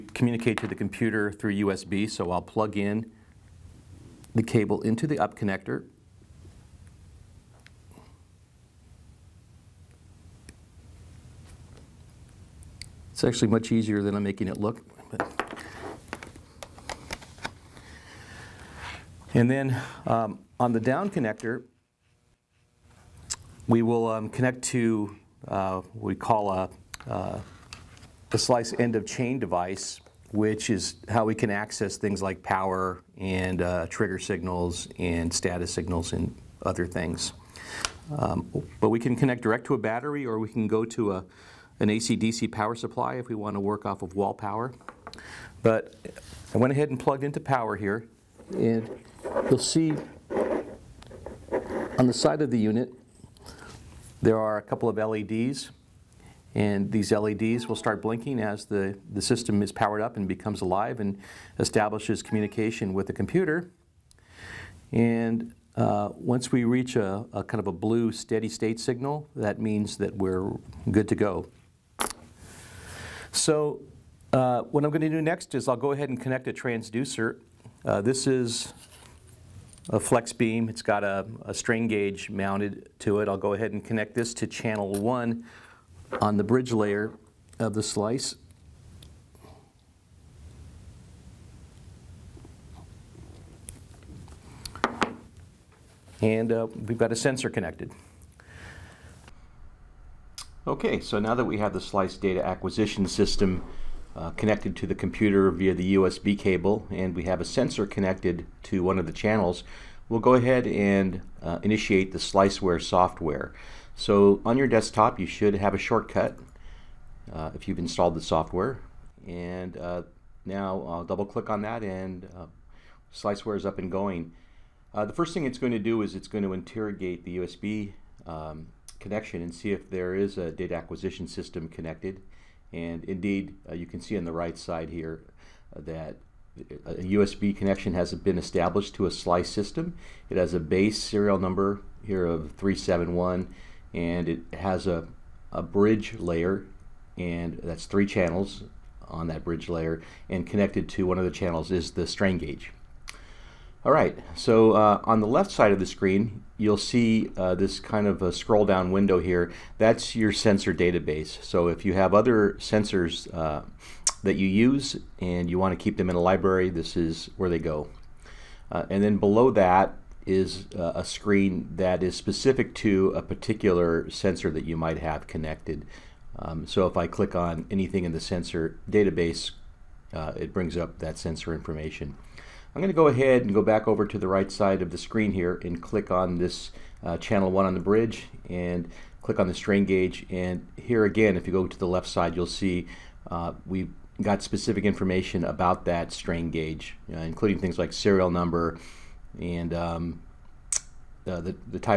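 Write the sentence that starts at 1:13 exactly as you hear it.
So uh, what I'm going to do next is I'll go ahead and connect a transducer.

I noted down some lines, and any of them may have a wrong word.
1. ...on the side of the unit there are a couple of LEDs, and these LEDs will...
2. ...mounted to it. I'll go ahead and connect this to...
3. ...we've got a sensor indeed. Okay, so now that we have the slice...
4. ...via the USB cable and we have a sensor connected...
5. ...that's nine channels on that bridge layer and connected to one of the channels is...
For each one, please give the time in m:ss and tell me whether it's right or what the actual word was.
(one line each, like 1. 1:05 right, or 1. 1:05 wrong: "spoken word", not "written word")
1. 0:51 right
2. 1:22 right
3. 1:36 wrong: "connected", not "indeed"
4. 1:45 right
5. 2:27 wrong: "three", not "nine".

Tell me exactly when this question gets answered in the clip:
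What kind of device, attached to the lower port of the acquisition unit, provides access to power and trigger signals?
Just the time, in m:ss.
0:28.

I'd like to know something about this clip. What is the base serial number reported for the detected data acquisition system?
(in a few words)
371.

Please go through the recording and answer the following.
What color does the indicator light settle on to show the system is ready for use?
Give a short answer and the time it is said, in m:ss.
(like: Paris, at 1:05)
blue, at 1:07.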